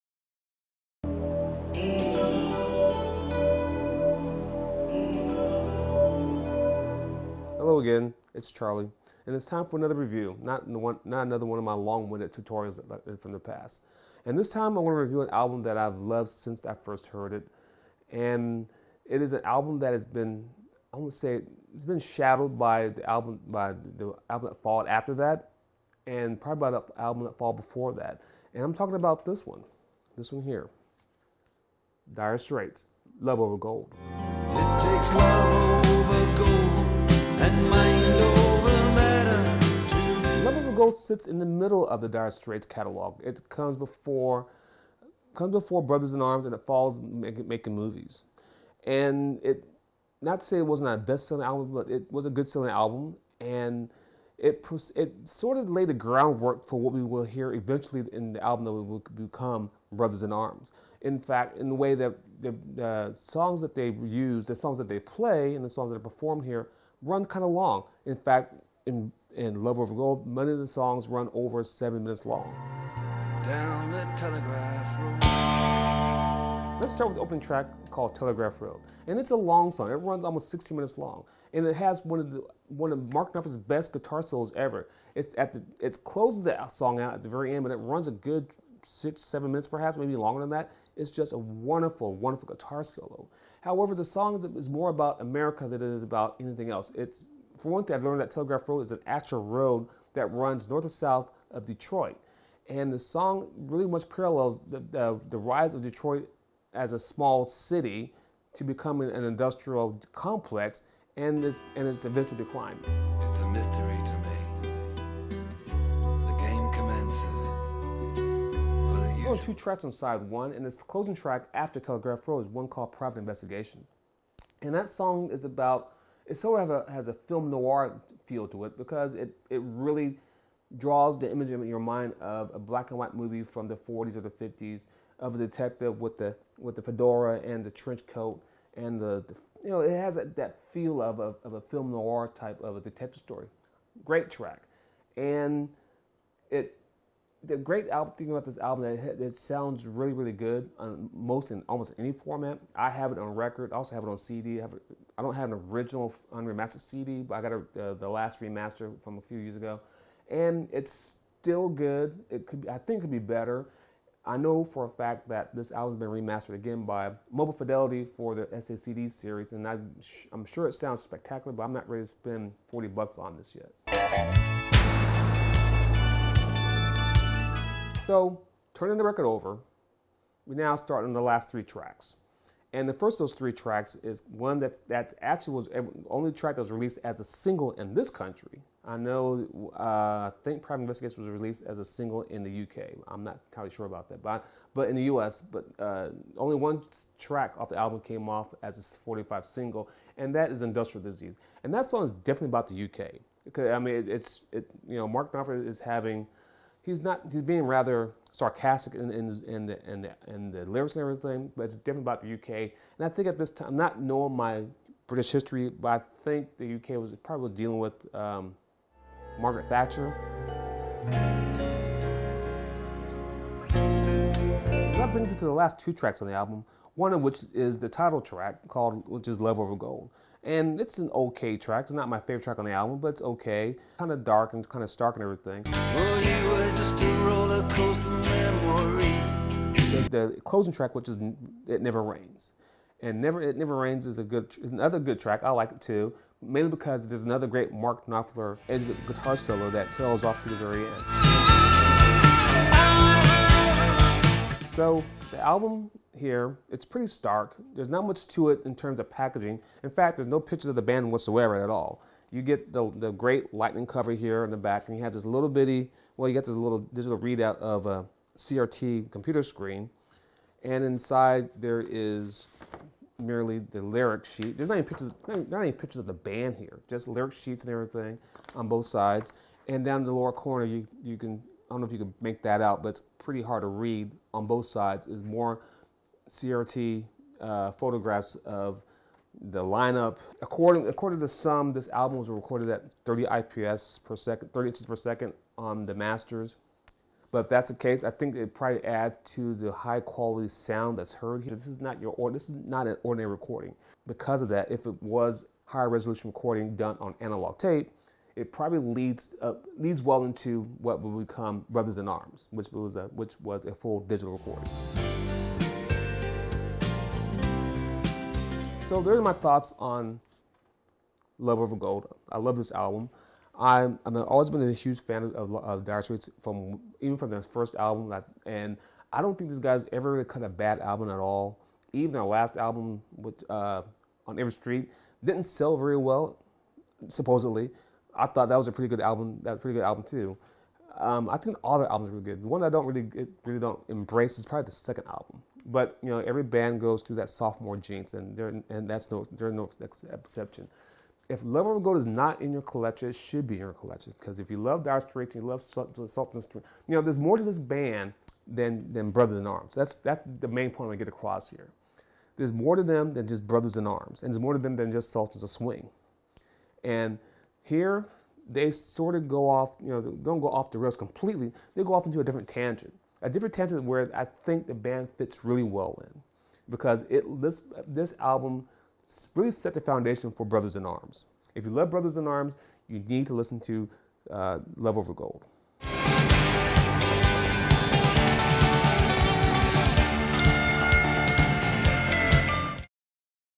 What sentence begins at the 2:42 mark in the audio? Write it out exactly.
It could I think could be better.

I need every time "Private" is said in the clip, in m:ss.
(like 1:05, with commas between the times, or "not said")
2:02, 3:10.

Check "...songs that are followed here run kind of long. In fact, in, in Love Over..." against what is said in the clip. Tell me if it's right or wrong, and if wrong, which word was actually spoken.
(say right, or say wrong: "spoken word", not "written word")
wrong: "performed", not "followed".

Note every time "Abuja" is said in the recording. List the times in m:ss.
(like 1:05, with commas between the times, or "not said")
not said.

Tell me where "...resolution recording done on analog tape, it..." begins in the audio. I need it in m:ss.
5:05.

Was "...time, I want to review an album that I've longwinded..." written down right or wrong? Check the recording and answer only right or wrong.
wrong.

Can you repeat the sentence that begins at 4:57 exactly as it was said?
But if that's the case, I think it probably adds to the high quality sound that's heard here.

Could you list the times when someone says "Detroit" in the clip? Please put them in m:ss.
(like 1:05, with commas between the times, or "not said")
1:41, 1:45.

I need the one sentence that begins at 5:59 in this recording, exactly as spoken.
That's that's the main point I get across here.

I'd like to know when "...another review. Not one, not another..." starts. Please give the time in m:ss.
0:09.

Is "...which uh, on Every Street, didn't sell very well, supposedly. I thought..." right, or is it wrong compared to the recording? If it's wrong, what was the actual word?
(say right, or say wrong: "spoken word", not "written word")
right.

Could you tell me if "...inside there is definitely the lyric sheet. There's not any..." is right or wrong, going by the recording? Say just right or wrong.
wrong.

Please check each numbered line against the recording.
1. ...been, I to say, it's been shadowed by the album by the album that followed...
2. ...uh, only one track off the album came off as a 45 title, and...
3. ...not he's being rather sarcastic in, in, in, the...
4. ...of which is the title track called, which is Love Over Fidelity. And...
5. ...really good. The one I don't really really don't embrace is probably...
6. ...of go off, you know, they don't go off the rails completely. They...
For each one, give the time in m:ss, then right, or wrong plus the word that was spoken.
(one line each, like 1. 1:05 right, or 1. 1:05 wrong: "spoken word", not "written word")
1. 0:20 right
2. 3:15 wrong: "single", not "title"
3. 3:27 right
4. 3:47 wrong: "Gold", not "Fidelity"
5. 5:42 right
6. 6:09 right.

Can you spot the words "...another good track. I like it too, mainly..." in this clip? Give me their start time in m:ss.
4:04.